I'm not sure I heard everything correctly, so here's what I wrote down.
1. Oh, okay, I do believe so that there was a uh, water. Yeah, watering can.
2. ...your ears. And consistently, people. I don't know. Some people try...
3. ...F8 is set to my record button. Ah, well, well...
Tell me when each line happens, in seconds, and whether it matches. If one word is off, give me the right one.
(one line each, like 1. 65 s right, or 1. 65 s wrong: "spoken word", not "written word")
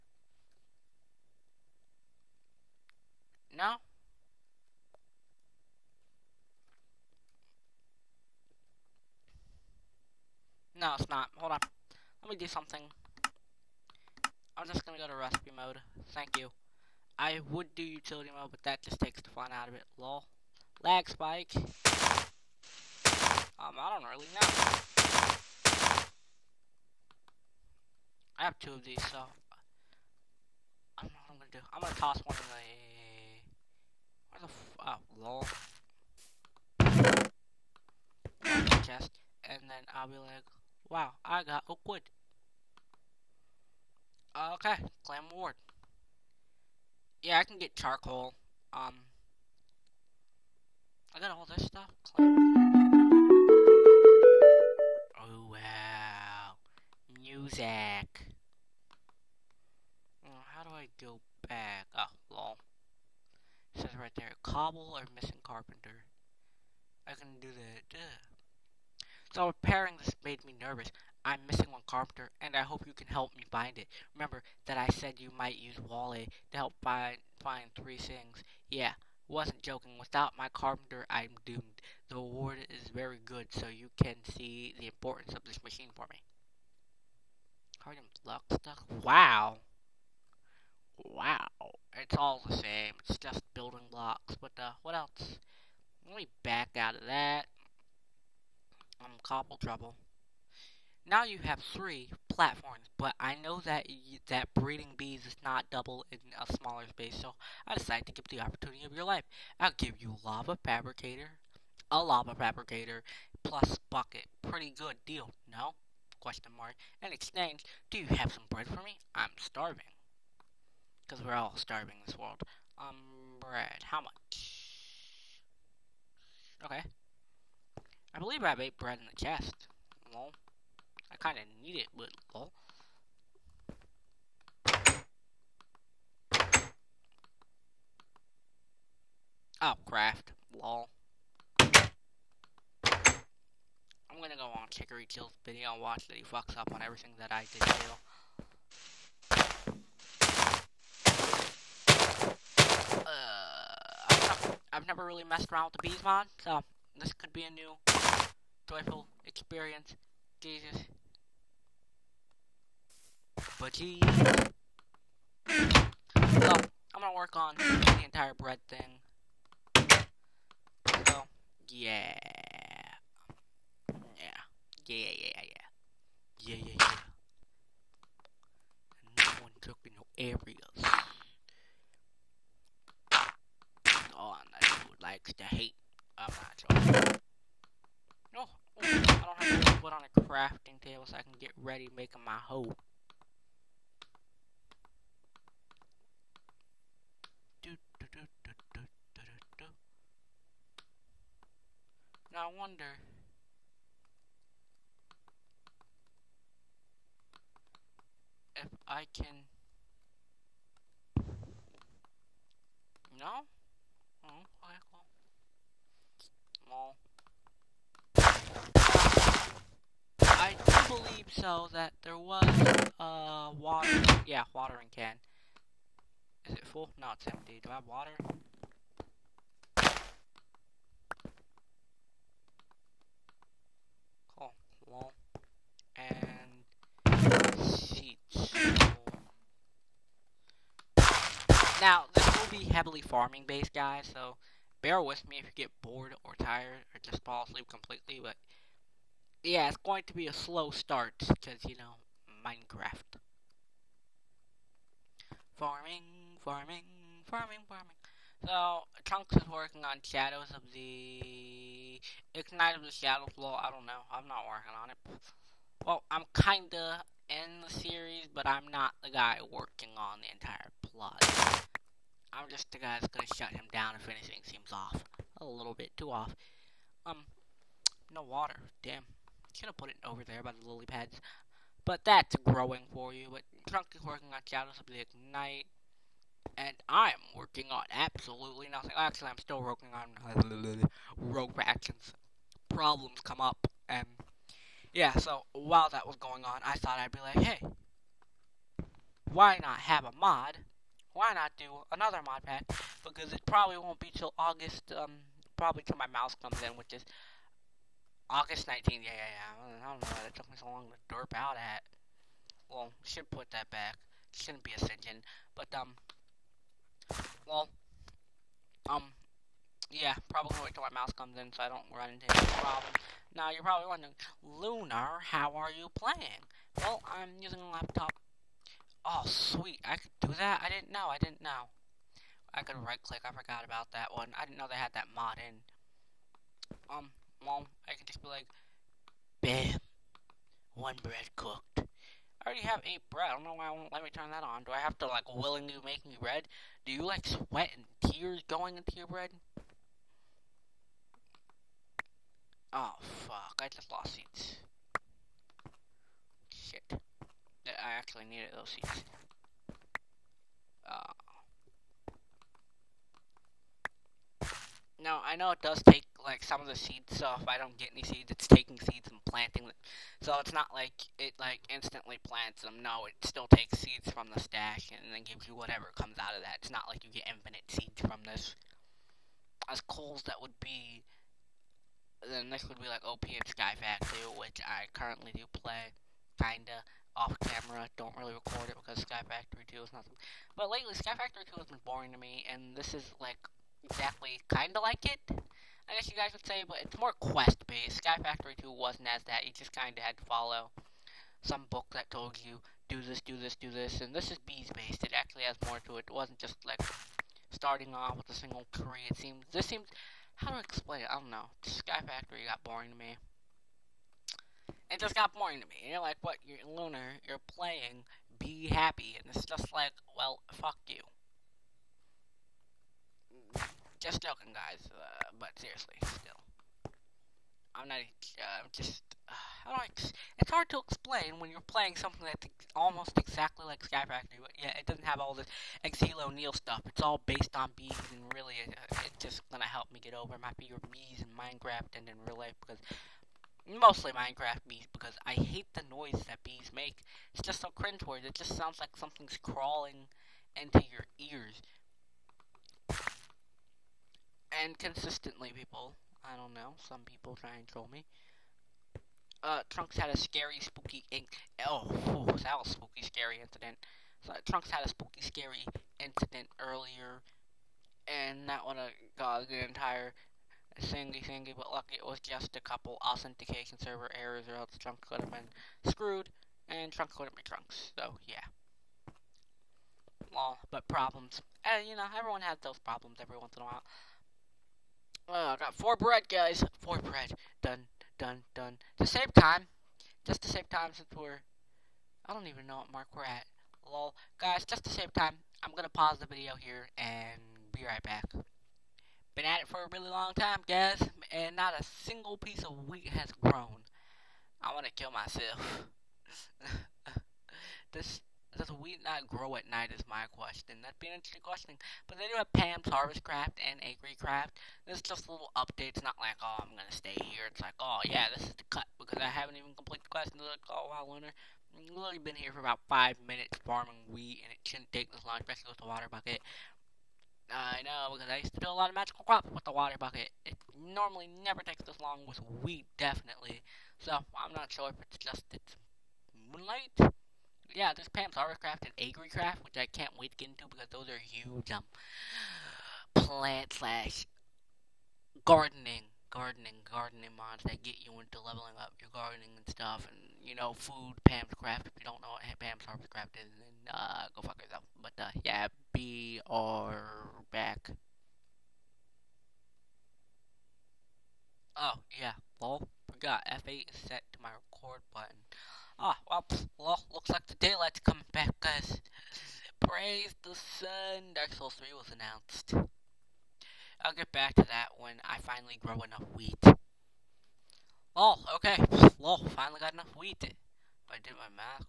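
1. 214 s right
2. 450 s right
3. 563 s right.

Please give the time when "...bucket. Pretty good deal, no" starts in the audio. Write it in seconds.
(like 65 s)
113 s.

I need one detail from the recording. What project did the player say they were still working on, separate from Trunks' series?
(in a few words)
Rogue factions.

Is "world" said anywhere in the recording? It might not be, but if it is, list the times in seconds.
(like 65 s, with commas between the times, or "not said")
122 s.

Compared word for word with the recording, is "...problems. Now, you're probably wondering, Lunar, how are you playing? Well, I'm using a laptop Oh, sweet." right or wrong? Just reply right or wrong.
right.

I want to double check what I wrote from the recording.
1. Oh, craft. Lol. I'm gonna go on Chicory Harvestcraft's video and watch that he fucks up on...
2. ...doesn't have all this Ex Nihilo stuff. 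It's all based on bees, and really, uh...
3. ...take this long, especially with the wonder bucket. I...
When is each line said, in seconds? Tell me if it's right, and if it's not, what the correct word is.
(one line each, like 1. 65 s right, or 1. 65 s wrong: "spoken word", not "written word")
1. 139 s wrong: "Kill", not "Harvestcraft"
2. 434 s right
3. 524 s wrong: "water", not "wonder".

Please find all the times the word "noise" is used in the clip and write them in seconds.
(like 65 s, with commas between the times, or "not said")
445 s.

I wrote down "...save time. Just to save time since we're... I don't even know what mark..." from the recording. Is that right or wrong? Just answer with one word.
right.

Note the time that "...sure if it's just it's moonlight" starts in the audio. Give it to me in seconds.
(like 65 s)
534 s.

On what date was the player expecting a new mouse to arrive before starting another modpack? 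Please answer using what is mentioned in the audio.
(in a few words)
August 19.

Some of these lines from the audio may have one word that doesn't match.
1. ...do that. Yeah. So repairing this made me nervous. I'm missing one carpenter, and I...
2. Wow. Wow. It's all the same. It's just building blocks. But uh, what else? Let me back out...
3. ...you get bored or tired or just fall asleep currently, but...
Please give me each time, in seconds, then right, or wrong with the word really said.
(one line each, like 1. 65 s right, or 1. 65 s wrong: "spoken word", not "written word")
1. 67 s right
2. 89 s right
3. 245 s wrong: "completely", not "currently".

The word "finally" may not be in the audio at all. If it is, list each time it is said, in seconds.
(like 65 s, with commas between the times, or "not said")
575 s, 579 s.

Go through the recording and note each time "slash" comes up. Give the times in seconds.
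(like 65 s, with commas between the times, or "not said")
543 s.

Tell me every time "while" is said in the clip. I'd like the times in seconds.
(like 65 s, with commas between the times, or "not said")
295 s, 483 s.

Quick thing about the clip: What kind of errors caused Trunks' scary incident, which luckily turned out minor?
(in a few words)
Authentication server errors.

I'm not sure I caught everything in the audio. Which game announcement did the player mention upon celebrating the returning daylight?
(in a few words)
Dark Souls 3.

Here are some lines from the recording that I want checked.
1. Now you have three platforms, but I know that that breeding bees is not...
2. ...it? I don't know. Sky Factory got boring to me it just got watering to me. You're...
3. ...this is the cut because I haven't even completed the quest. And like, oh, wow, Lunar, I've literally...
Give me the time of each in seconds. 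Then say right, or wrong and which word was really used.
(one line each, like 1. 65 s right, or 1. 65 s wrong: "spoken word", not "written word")
1. 101 s right
2. 411 s wrong: "boring", not "watering"
3. 518 s right.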